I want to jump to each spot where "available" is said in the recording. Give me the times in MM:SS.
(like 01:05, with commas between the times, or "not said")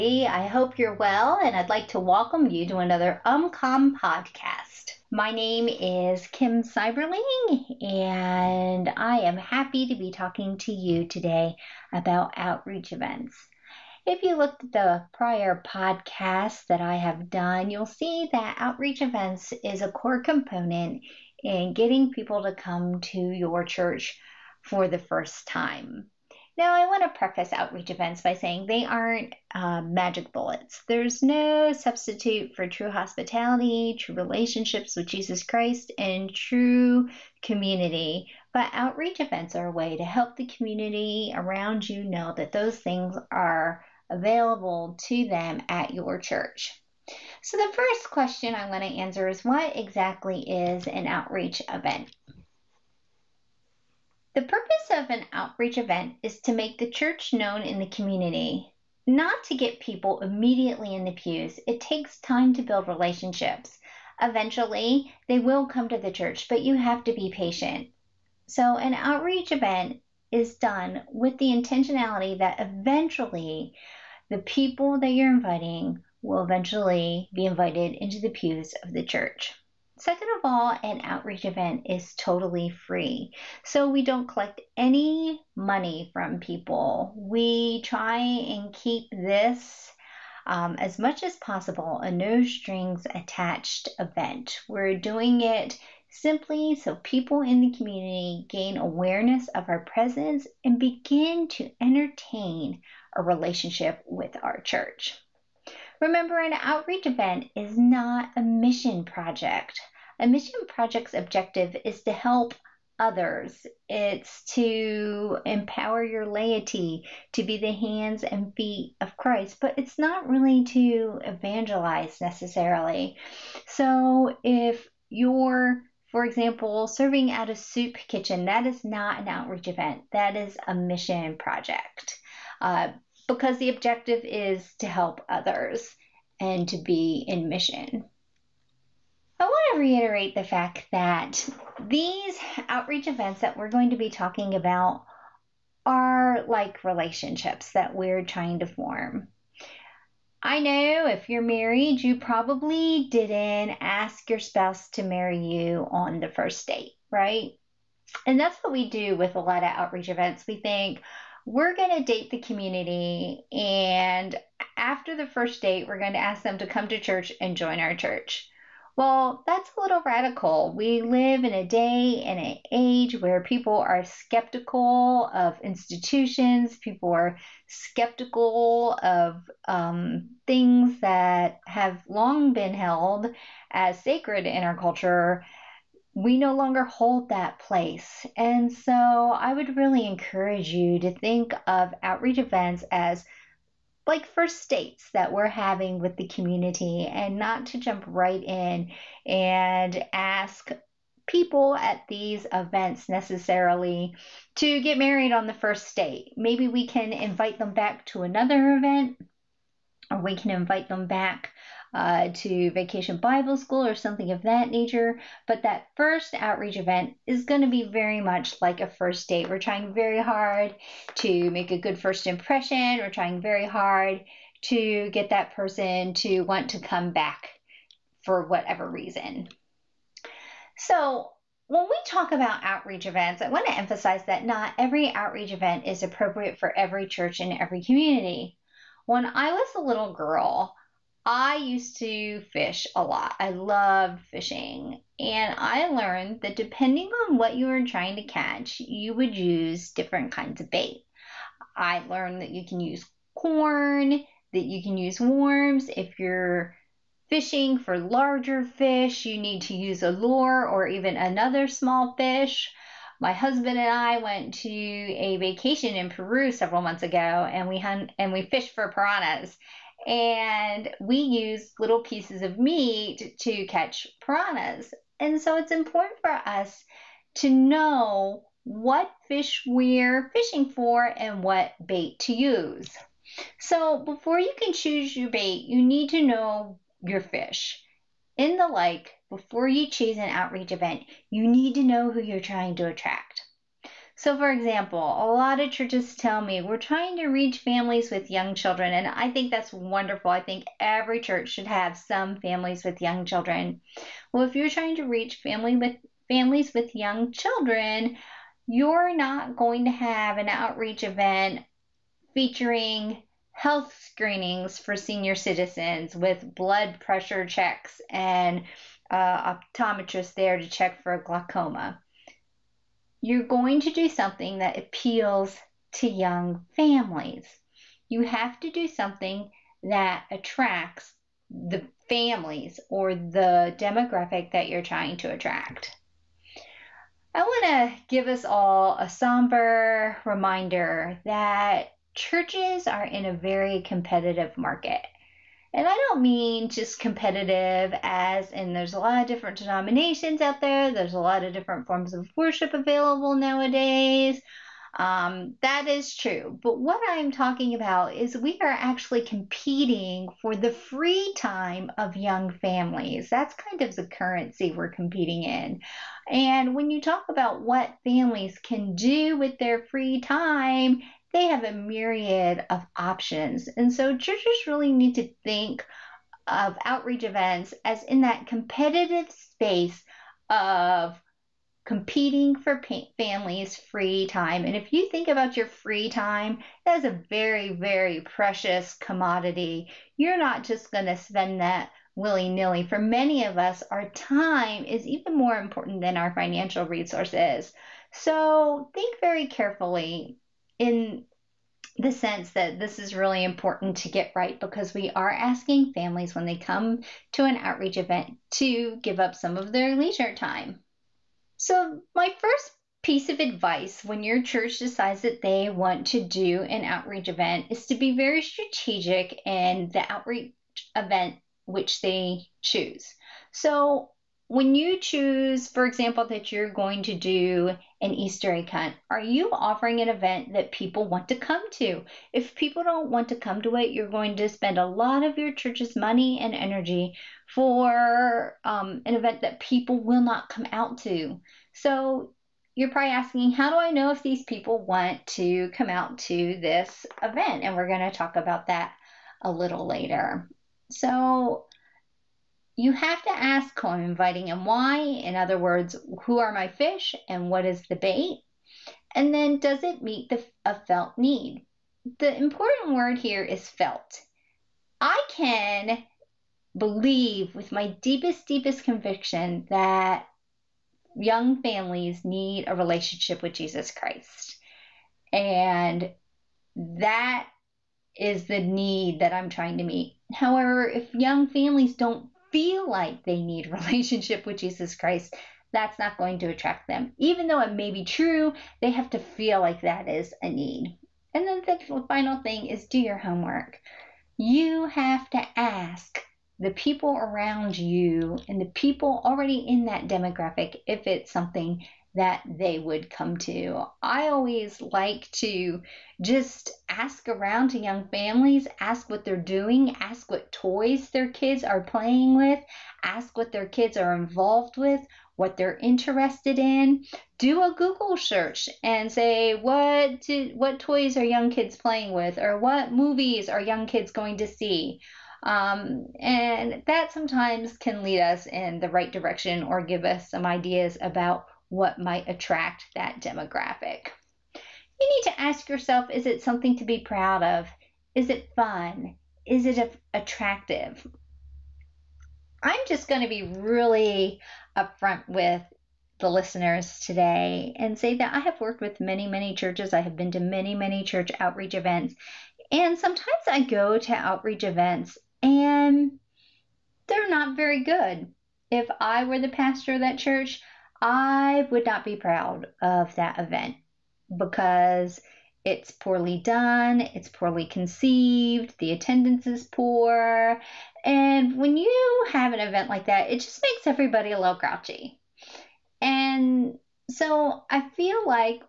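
00:44, 05:52.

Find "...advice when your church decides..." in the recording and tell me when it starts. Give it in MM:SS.
06:53.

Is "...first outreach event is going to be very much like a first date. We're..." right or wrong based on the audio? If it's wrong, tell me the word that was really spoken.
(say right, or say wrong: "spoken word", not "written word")
right.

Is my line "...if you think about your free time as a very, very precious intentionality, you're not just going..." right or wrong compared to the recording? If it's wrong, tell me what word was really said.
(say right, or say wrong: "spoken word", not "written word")
wrong: "commodity", not "intentionality".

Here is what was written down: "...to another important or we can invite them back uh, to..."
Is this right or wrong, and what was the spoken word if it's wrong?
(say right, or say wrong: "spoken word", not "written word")
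wrong: "event", not "important".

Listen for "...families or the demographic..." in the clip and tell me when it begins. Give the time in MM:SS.
05:32.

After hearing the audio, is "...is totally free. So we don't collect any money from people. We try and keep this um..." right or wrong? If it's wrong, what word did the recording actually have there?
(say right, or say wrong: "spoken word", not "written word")
right.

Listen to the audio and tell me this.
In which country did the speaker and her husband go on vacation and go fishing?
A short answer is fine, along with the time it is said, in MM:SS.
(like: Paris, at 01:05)
Peru, at 04:26.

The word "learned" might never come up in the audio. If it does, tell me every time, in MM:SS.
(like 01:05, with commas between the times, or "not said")
04:05, 04:12.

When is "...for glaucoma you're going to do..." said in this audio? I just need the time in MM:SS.
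05:21.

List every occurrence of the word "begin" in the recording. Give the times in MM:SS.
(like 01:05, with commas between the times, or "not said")
01:40.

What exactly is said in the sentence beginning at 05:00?
I think every church should have some families with young children.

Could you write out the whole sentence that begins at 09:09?
I have been to many, many church outreach events.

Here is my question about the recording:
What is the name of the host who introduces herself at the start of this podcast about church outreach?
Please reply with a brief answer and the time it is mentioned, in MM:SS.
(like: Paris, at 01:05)
Kim Seiberling, at 00:06.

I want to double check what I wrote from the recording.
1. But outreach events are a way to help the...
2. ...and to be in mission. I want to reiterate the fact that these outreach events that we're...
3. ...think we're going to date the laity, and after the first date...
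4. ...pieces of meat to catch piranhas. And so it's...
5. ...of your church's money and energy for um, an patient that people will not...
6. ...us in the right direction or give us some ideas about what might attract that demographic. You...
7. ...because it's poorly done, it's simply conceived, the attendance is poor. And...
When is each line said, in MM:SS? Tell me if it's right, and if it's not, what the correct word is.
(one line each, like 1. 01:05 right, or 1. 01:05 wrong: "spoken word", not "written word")
1. 00:38 right
2. 02:16 right
3. 02:40 wrong: "community", not "laity"
4. 04:32 right
5. 07:15 wrong: "event", not "patient"
6. 08:48 right
7. 09:24 wrong: "poorly", not "simply".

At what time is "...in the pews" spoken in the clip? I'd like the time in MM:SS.
01:00.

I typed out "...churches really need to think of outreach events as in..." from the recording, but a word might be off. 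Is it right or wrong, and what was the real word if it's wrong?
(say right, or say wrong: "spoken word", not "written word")
right.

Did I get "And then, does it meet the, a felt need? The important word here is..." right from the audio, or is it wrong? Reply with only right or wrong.
right.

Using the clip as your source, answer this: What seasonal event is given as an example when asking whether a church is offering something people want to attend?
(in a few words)
Easter egg hunt.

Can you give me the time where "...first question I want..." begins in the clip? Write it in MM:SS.
00:47.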